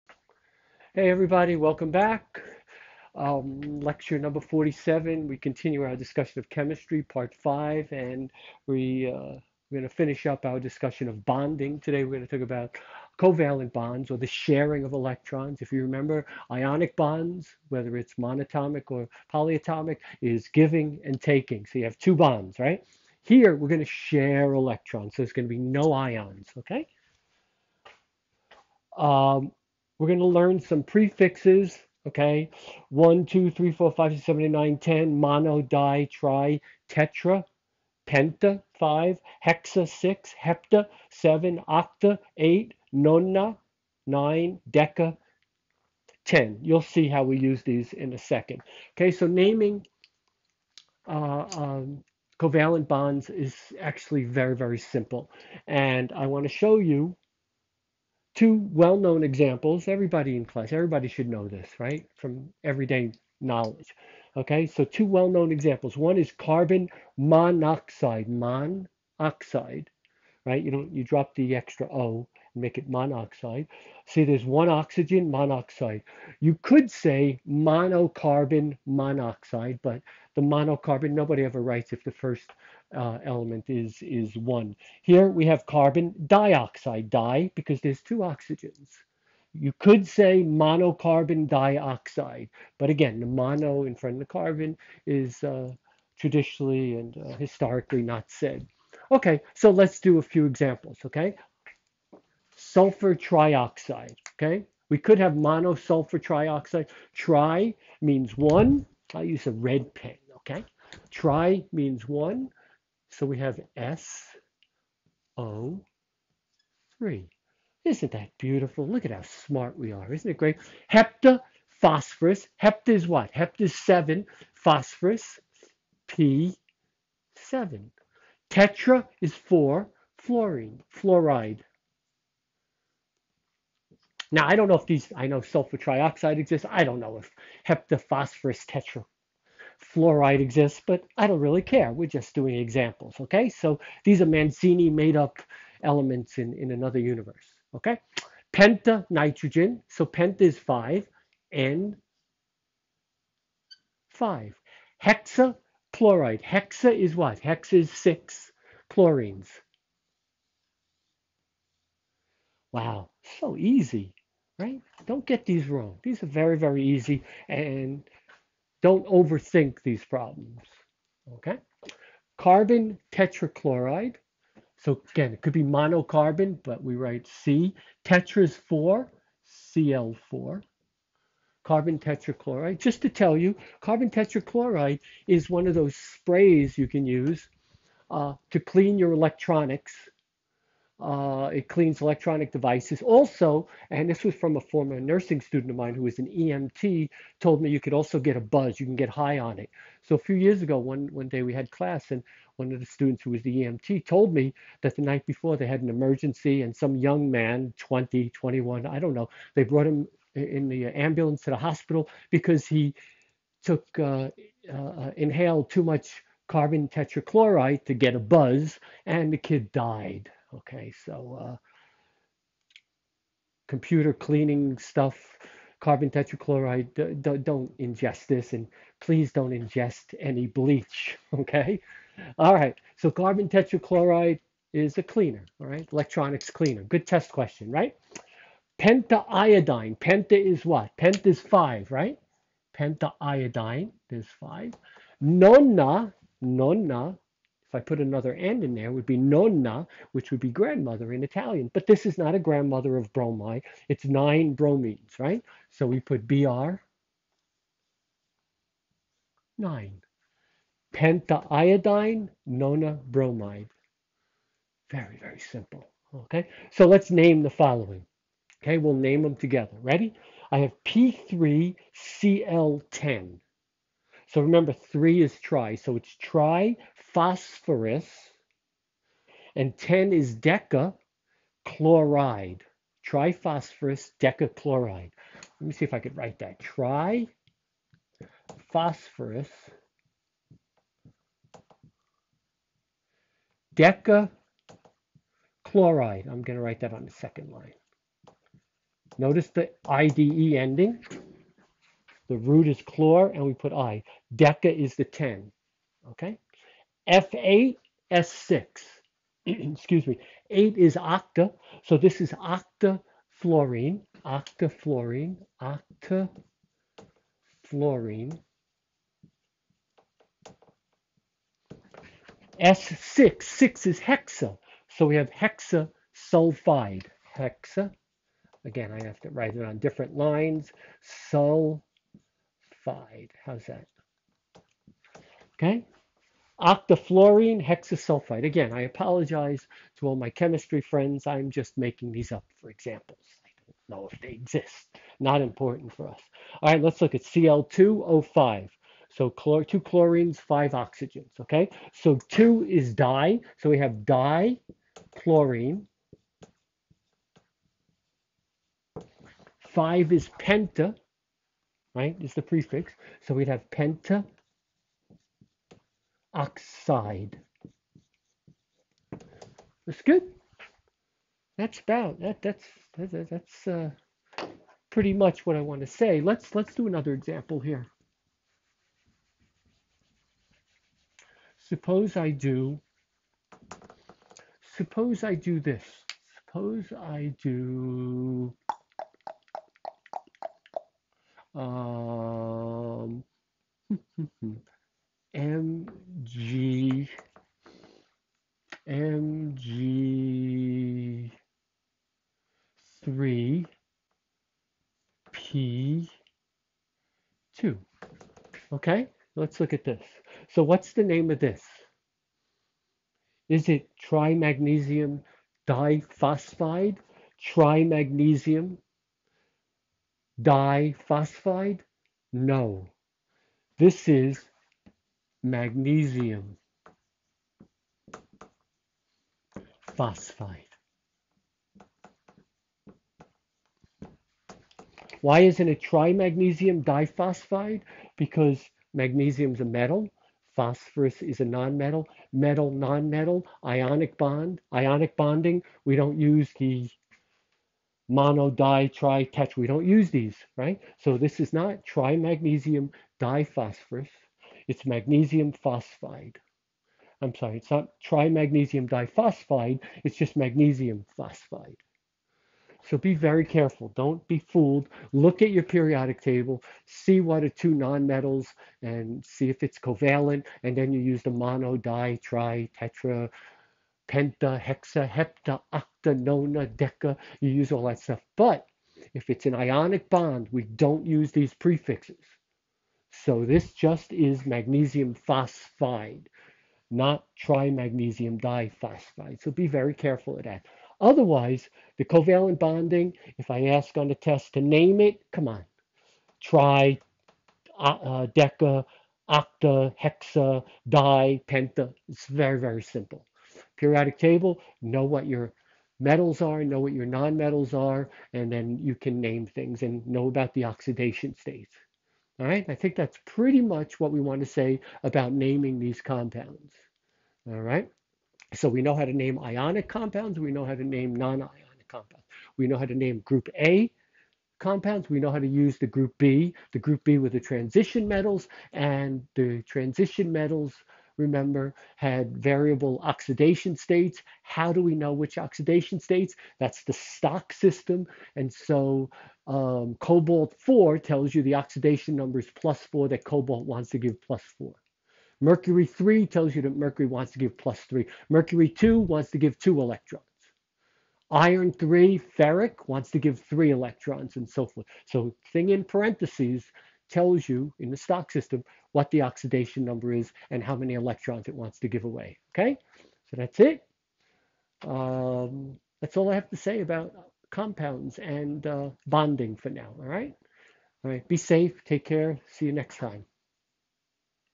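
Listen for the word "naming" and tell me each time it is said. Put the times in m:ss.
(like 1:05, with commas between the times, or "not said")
0:49, 8:35.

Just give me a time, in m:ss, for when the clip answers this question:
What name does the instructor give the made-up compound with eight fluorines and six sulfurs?
5:36.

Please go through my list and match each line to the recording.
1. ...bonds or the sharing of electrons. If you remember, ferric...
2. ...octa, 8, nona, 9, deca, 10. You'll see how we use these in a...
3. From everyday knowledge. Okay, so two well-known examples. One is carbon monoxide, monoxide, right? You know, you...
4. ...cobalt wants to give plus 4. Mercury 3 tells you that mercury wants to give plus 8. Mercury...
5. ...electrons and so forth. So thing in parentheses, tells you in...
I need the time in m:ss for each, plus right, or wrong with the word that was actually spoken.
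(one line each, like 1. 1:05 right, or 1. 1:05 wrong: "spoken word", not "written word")
1. 0:13 wrong: "ionic", not "ferric"
2. 0:41 right
3. 1:02 right
4. 9:03 wrong: "3", not "8"
5. 9:13 right.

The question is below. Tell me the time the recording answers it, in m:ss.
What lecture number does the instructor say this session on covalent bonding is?
0:04.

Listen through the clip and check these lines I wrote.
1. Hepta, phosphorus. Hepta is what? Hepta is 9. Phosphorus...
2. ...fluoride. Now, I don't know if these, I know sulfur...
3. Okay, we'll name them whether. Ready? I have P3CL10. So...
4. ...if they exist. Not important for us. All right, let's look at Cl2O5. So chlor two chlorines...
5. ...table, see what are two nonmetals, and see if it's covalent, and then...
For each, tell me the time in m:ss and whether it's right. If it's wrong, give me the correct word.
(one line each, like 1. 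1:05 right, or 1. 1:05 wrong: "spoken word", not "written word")
1. 2:00 wrong: "7", not "9"
2. 2:10 right
3. 4:28 wrong: "together", not "whether"
4. 5:44 right
5. 7:46 right.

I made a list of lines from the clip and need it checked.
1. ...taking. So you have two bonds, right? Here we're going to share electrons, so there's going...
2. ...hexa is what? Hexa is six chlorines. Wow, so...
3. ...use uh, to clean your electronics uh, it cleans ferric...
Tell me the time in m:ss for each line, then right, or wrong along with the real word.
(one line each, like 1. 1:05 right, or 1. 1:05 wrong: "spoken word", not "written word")
1. 0:21 right
2. 2:36 right
3. 3:07 wrong: "electronic", not "ferric".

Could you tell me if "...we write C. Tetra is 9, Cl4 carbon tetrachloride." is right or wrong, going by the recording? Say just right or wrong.
wrong.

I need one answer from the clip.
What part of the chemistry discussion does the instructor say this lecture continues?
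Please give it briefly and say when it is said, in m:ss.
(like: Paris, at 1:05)
part 5, at 0:07.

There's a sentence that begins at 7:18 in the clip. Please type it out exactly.
Because magnesium is a metal, phosphorus is a nonmetal, metal, nonmetal, ionic bond, ionic bonding.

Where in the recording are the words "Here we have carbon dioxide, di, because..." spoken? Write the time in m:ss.
1:25.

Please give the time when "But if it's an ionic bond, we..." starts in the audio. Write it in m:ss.
7:58.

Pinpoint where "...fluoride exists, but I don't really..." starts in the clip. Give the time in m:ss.
2:19.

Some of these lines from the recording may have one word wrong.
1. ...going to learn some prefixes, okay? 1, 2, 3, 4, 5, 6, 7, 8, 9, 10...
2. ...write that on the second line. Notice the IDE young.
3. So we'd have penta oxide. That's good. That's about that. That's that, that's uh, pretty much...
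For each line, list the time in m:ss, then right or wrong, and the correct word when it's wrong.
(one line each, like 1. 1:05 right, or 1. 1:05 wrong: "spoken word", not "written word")
1. 0:30 right
2. 4:56 wrong: "ending", not "young"
3. 6:03 right.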